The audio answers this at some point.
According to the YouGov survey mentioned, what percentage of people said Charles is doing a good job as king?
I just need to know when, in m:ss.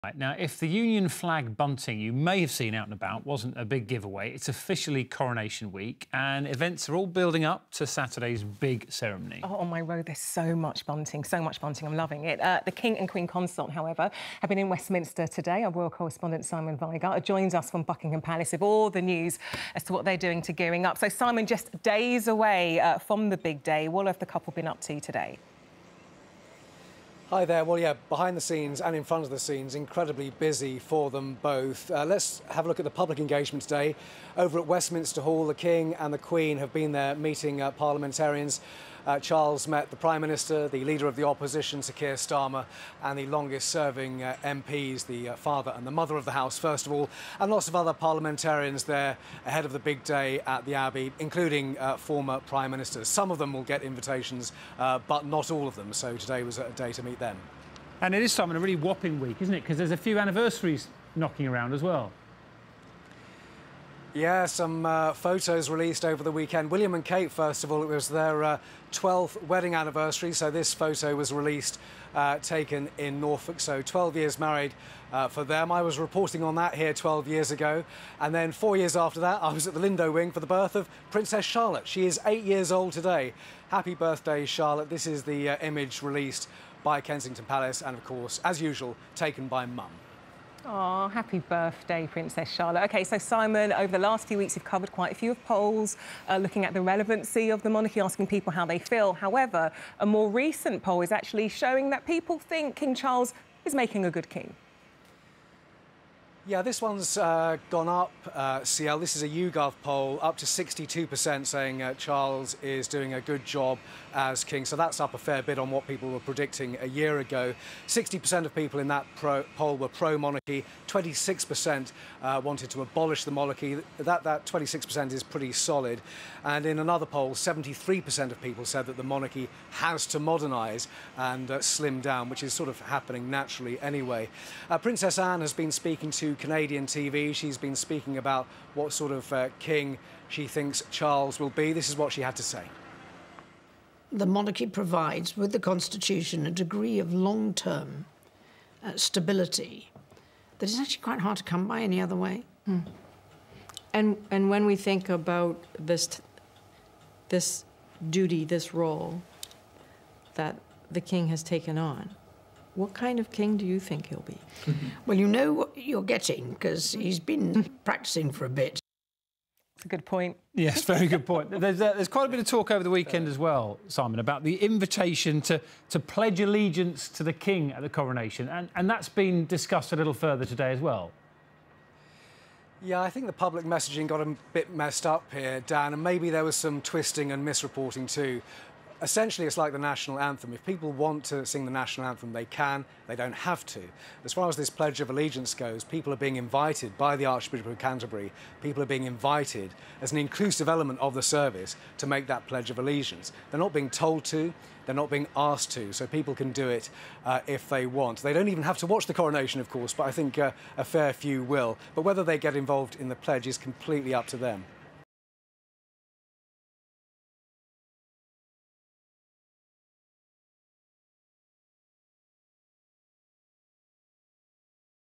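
1:50.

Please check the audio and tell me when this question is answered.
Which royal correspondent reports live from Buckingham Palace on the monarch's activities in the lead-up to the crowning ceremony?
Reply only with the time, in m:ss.
0:16.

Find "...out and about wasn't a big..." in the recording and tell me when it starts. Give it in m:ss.
0:02.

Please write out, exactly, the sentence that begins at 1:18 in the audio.
And then four years after that, I was at the Lindo Wing for the birth of Princess Charlotte.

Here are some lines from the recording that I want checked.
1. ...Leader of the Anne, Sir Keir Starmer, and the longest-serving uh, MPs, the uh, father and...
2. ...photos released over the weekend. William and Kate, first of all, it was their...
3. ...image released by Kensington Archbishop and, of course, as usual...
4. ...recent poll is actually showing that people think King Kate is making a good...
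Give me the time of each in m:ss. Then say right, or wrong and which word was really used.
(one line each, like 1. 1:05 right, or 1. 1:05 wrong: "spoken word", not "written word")
1. 0:40 wrong: "Opposition", not "Anne"
2. 1:05 right
3. 1:25 wrong: "Palace", not "Archbishop"
4. 1:40 wrong: "Charles", not "Kate".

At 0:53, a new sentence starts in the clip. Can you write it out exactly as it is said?
Some of them will get invitations, uh, but not all of them, so today was a day to meet them.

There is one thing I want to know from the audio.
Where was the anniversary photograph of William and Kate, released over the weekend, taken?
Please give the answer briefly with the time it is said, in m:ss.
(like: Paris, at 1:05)
Norfolk, at 1:13.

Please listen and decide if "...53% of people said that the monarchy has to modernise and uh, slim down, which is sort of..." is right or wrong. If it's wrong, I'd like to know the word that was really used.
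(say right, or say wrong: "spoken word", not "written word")
wrong: "73", not "53".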